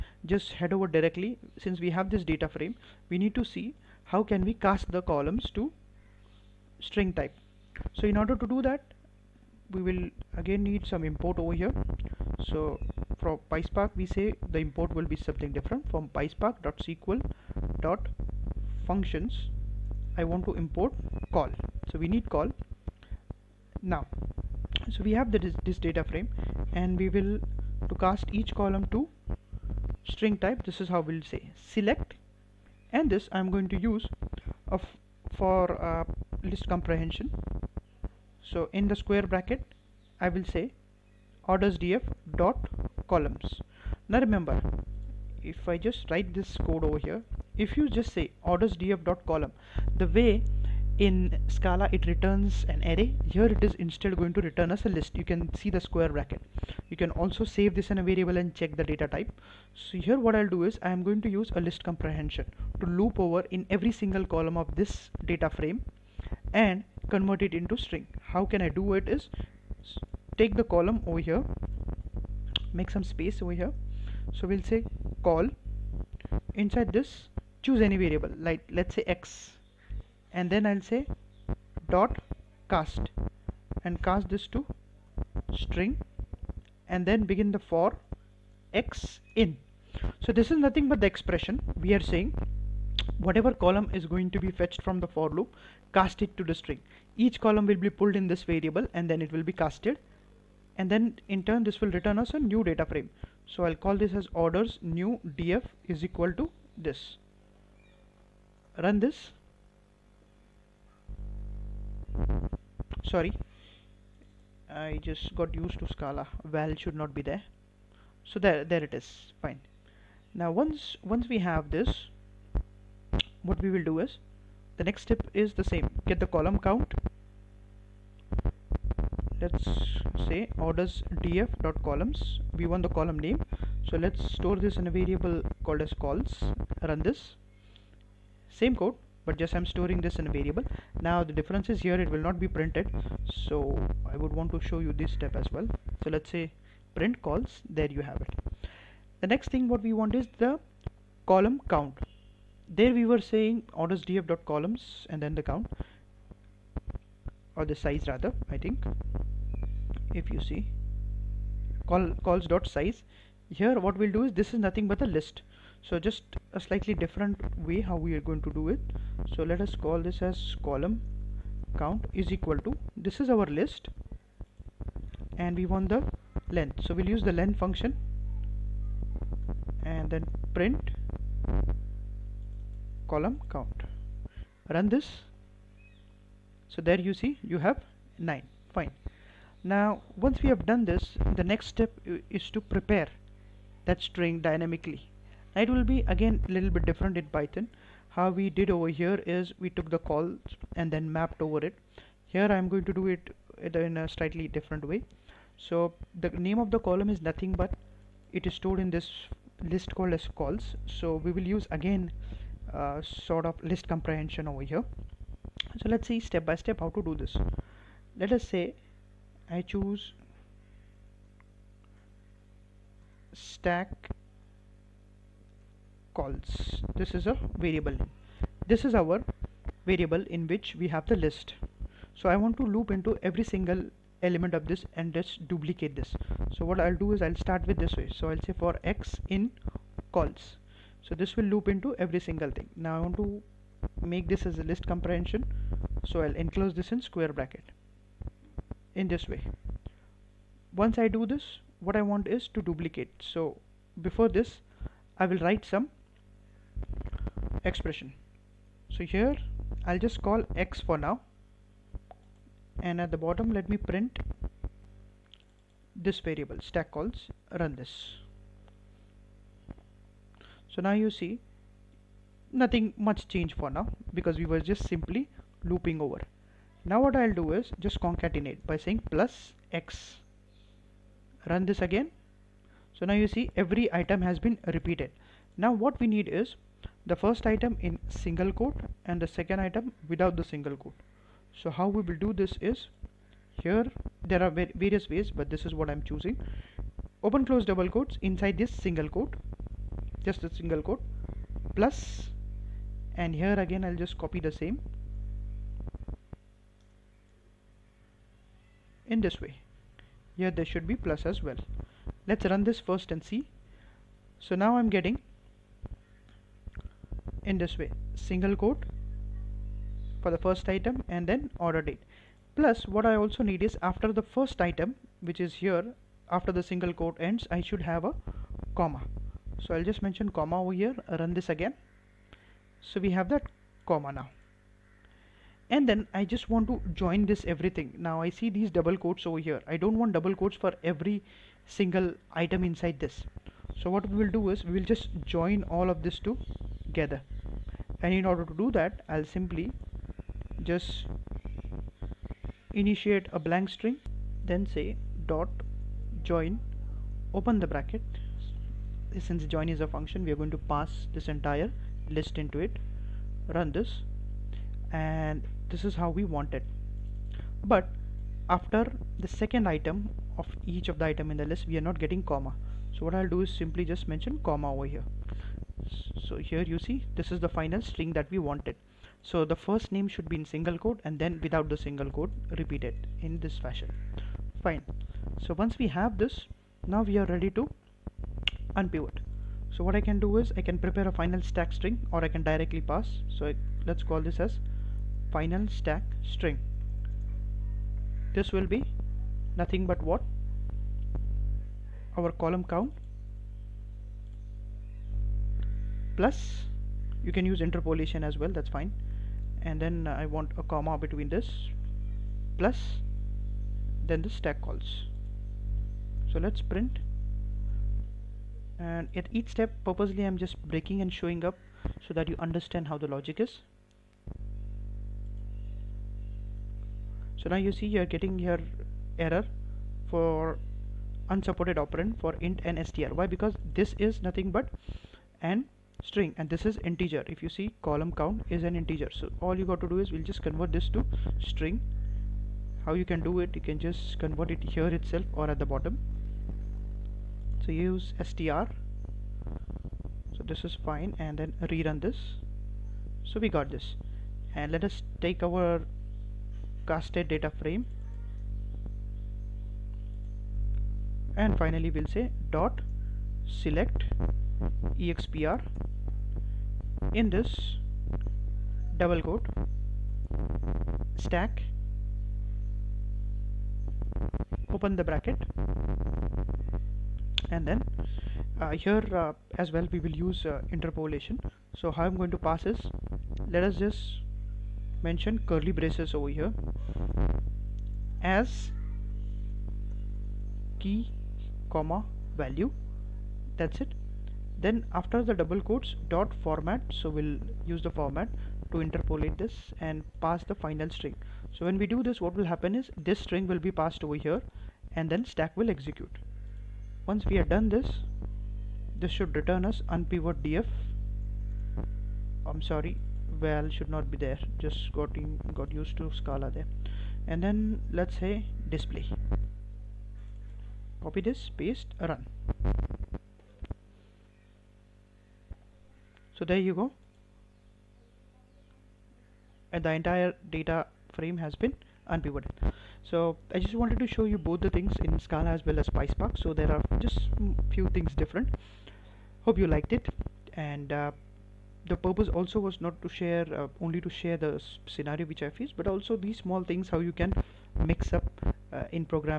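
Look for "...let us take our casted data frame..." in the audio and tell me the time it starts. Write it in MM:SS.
07:34.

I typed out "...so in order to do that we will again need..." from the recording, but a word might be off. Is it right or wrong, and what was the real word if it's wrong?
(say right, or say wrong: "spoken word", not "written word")
right.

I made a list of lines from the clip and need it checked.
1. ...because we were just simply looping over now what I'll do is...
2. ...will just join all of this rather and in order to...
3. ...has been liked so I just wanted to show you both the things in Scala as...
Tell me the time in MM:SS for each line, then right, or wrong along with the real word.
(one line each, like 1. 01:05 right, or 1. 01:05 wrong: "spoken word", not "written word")
1. 04:34 right
2. 05:44 wrong: "together", not "rather"
3. 08:51 wrong: "unpivoted", not "liked".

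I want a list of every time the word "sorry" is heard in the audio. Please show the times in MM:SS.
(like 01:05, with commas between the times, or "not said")
01:53, 08:32.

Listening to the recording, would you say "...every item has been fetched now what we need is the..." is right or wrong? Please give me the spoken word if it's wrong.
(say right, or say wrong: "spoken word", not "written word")
wrong: "repeated", not "fetched".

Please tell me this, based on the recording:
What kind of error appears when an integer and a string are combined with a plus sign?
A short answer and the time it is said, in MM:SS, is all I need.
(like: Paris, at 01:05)
unsupported operand, at 07:11.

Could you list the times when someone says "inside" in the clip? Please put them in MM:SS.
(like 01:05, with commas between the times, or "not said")
01:16, 04:58, 05:42.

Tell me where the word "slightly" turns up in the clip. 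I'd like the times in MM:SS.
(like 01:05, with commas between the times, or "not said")
02:46, 03:24.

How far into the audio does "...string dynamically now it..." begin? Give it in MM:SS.
03:14.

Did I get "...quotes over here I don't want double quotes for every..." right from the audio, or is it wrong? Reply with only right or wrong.
right.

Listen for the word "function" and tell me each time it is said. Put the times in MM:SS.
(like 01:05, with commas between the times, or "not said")
00:18, 02:57, 05:59.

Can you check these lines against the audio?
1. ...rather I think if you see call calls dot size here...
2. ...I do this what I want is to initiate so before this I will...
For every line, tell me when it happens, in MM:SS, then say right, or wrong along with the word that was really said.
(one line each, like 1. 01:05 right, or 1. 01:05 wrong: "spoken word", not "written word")
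1. 02:38 right
2. 04:10 wrong: "duplicate", not "initiate".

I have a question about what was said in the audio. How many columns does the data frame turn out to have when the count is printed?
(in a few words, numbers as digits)
9.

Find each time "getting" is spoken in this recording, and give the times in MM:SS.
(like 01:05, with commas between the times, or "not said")
05:14, 06:11, 07:08.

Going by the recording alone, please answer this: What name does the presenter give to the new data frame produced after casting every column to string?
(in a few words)
orders new df.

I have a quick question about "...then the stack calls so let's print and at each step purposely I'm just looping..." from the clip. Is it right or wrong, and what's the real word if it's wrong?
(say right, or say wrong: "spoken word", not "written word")
wrong: "breaking", not "looping".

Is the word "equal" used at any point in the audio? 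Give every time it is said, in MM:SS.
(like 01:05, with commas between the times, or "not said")
01:46, 02:52.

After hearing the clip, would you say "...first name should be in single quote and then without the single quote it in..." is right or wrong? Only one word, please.
right.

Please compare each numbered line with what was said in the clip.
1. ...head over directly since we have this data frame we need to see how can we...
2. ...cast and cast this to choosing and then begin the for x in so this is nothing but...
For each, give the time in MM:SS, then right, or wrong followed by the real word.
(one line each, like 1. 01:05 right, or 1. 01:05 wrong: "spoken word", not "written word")
1. 00:00 right
2. 01:22 wrong: "string", not "choosing".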